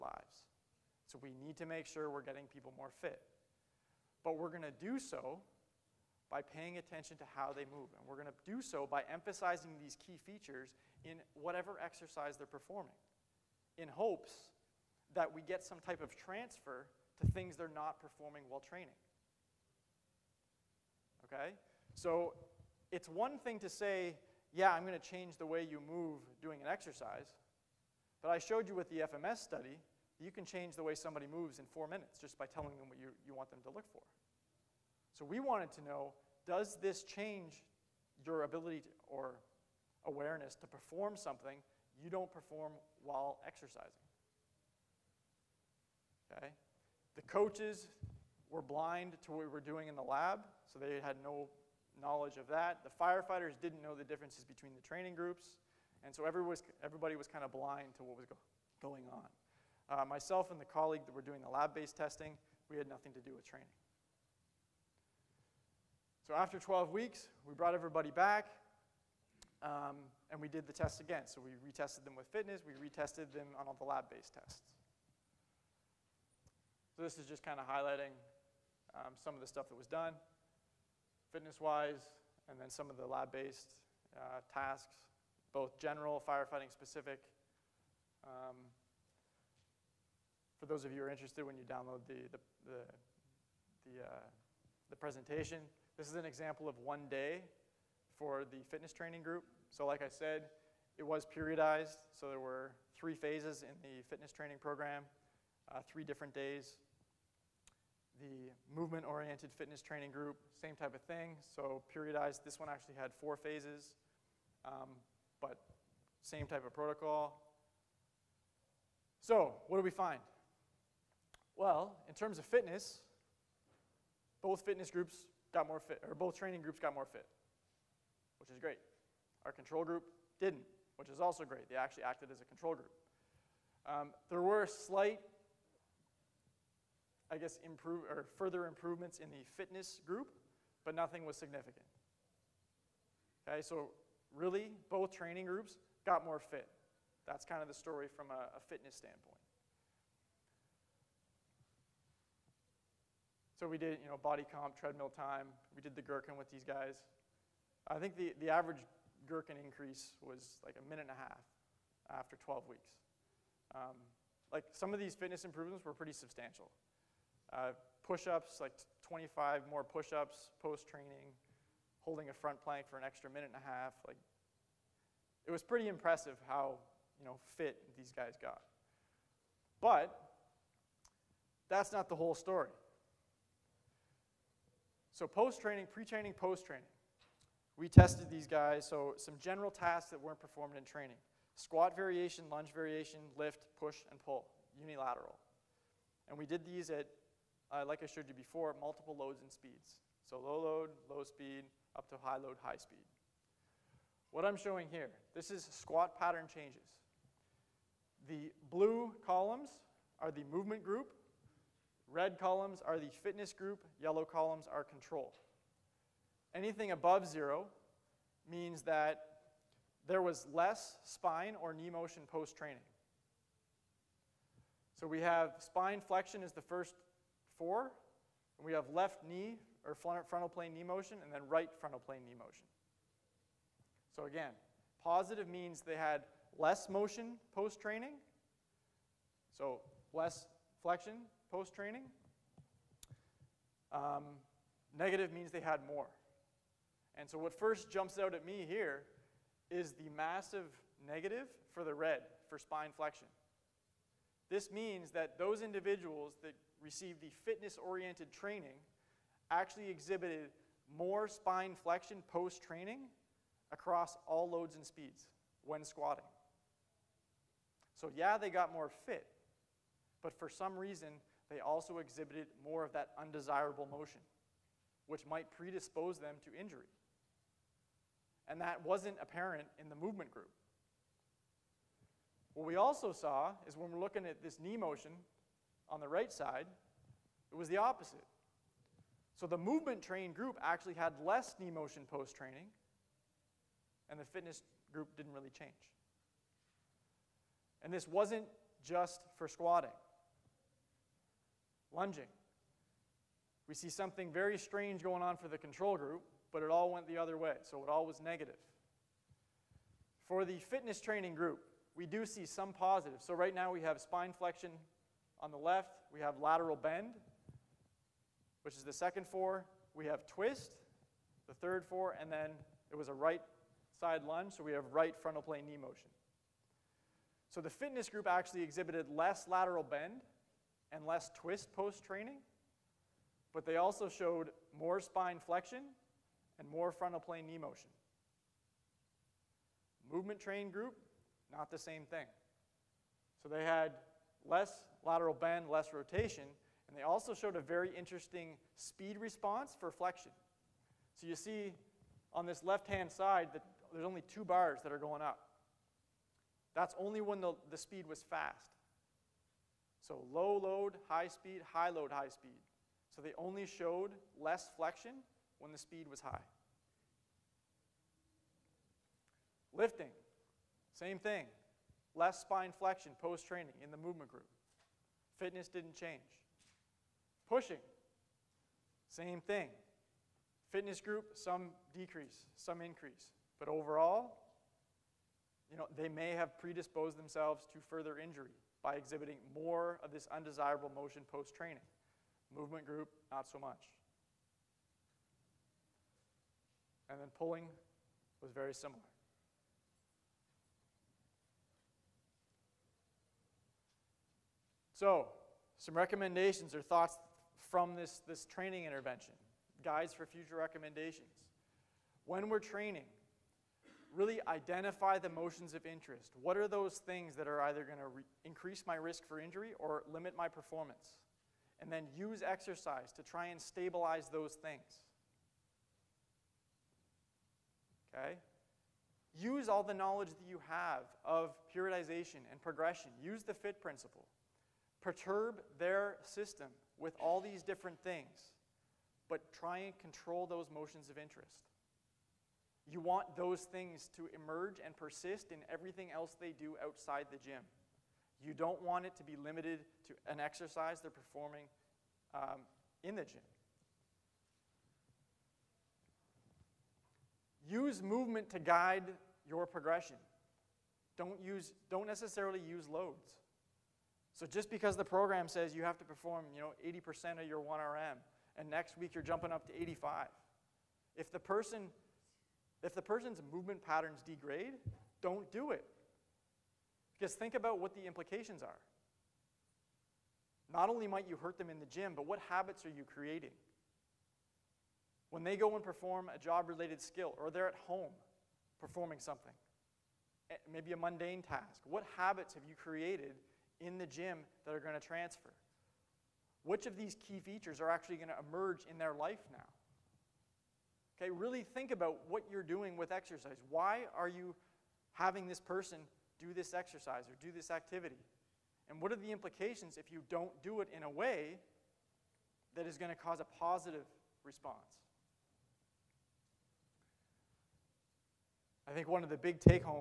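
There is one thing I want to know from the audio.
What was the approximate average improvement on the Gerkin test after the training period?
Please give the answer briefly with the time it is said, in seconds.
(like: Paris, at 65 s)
a minute and a half, at 160 s.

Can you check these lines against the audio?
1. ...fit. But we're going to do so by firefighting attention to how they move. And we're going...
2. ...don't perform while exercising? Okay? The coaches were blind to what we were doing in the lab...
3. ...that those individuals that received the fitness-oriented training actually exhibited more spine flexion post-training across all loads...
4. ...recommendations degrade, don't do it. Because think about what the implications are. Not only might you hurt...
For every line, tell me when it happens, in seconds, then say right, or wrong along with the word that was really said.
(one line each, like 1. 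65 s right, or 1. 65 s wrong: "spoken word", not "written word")
1. 3 s wrong: "paying", not "firefighting"
2. 42 s right
3. 255 s right
4. 473 s wrong: "patterns", not "recommendations".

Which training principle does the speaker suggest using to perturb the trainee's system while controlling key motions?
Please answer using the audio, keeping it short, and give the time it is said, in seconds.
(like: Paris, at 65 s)
FIT principle, at 433 s.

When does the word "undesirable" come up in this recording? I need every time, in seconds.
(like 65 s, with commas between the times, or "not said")
273 s, 390 s.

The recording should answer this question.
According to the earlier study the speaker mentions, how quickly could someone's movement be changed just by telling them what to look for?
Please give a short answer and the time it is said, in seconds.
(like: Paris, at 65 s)
4 minutes, at 31 s.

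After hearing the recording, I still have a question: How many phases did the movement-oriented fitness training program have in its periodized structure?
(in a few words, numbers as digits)
4.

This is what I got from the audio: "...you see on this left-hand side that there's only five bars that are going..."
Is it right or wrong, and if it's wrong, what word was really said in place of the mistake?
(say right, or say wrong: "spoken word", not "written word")
wrong: "two", not "five".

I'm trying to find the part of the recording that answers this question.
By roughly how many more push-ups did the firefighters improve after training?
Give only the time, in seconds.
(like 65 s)
169 s.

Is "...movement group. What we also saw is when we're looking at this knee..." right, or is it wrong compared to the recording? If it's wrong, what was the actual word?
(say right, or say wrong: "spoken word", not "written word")
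right.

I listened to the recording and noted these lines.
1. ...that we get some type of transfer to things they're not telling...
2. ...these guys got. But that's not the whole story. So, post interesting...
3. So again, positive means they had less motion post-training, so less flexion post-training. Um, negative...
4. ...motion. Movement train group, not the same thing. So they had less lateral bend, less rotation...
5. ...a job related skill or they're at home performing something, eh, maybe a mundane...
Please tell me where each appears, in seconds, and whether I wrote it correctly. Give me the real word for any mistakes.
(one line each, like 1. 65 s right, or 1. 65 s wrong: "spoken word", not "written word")
1. 15 s wrong: "performing", not "telling"
2. 177 s wrong: "training", not "interesting"
3. 234 s right
4. 337 s right
5. 486 s right.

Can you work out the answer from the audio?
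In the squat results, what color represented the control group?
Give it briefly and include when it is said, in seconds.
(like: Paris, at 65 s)
yellow, at 214 s.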